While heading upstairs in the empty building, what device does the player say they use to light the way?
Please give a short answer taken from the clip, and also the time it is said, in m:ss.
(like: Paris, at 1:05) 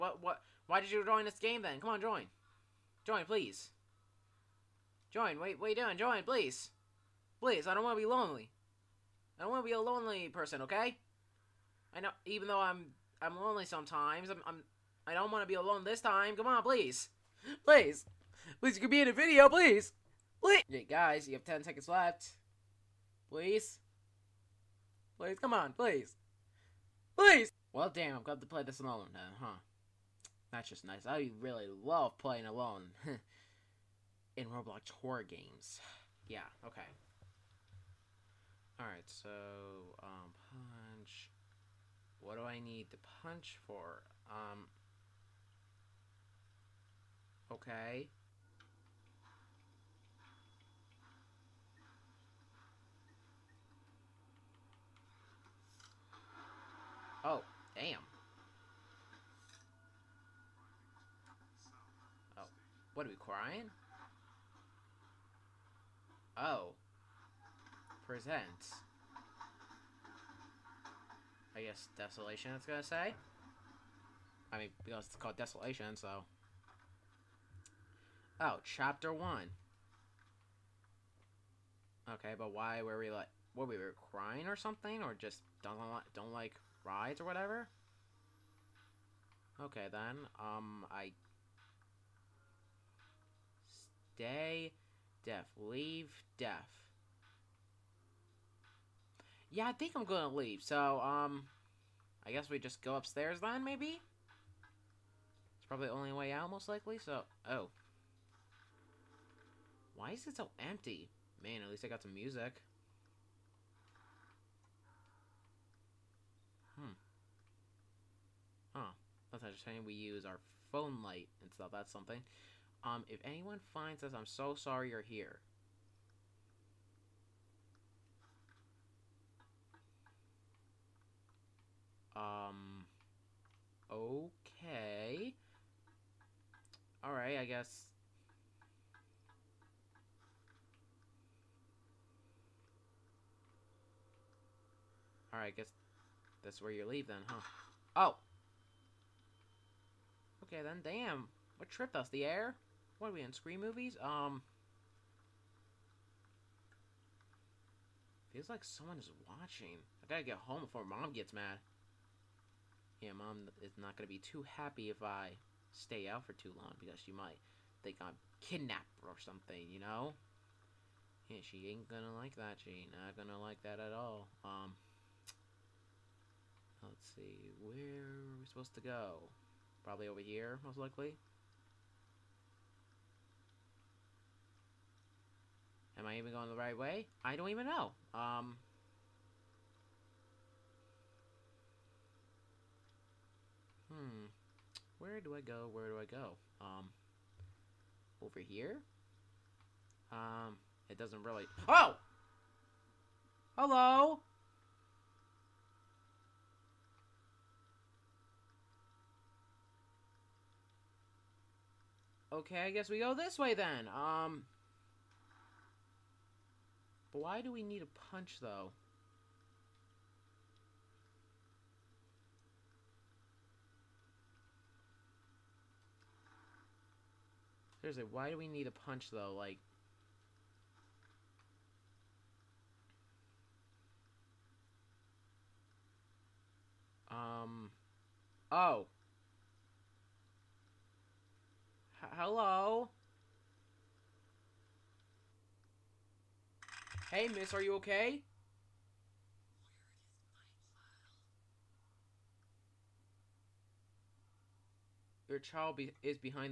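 Phone light, at 2:00.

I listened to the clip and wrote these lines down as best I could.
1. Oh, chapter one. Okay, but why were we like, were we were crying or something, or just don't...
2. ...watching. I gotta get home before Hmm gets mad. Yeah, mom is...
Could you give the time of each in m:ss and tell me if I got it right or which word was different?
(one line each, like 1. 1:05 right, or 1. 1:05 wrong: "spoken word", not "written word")
1. 1:18 right
2. 2:39 wrong: "Mom", not "Hmm".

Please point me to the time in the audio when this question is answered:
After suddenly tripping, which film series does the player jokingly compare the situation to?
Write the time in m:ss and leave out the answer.
2:33.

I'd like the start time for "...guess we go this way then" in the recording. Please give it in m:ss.
3:32.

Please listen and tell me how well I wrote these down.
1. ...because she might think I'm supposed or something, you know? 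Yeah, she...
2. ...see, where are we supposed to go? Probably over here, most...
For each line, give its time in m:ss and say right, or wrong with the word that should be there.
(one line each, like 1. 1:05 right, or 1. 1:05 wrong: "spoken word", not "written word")
1. 2:46 wrong: "kidnapped", not "supposed"
2. 2:57 right.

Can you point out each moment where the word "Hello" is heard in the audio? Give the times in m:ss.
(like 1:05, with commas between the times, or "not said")
3:23, 4:02.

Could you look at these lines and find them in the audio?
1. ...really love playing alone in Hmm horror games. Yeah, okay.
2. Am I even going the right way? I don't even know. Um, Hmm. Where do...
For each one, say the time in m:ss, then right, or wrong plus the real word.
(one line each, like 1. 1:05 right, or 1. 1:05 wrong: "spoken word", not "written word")
1. 0:31 wrong: "Roblox", not "Hmm"
2. 3:05 right.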